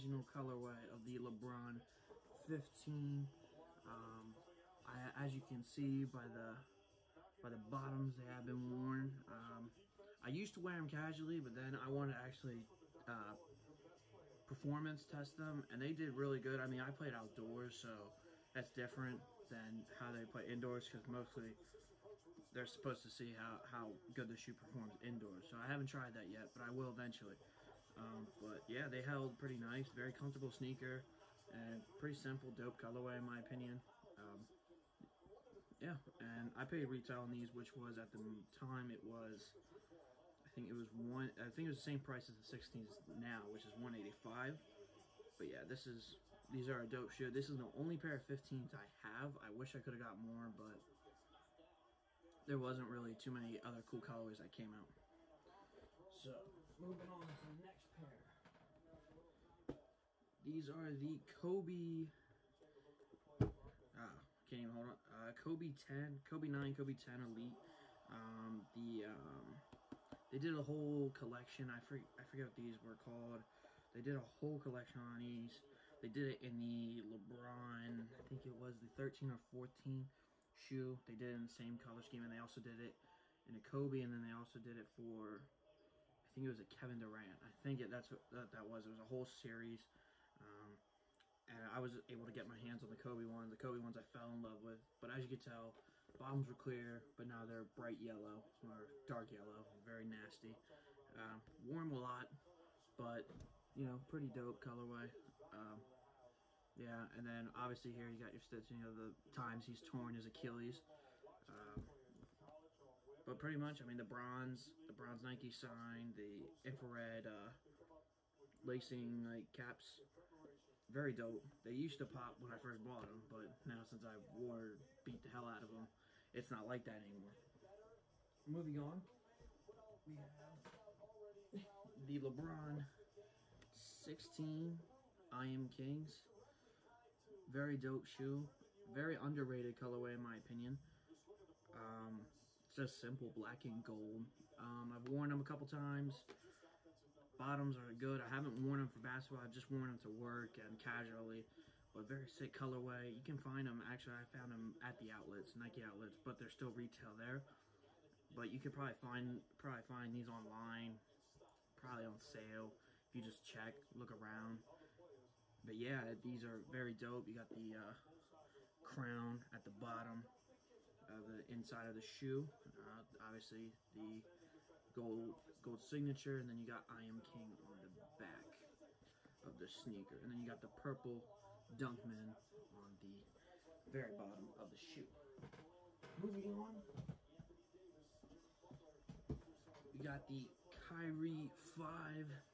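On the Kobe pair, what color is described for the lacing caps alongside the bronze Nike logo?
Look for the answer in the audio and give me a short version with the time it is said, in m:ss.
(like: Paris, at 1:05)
infrared, at 1:56.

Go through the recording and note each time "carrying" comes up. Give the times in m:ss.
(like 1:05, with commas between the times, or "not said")
not said.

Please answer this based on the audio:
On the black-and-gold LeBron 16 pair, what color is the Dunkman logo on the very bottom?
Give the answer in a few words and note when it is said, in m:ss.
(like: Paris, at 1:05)
purple, at 3:00.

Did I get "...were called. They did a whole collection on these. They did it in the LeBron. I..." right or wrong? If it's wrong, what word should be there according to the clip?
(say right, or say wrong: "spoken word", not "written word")
right.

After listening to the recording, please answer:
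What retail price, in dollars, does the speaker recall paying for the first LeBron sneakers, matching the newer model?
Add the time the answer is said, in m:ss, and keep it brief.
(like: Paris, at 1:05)
185, at 0:43.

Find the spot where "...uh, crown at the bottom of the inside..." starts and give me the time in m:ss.
2:47.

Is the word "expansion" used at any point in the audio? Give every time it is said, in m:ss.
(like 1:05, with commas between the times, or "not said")
not said.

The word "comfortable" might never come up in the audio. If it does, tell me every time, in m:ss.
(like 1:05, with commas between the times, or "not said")
0:30.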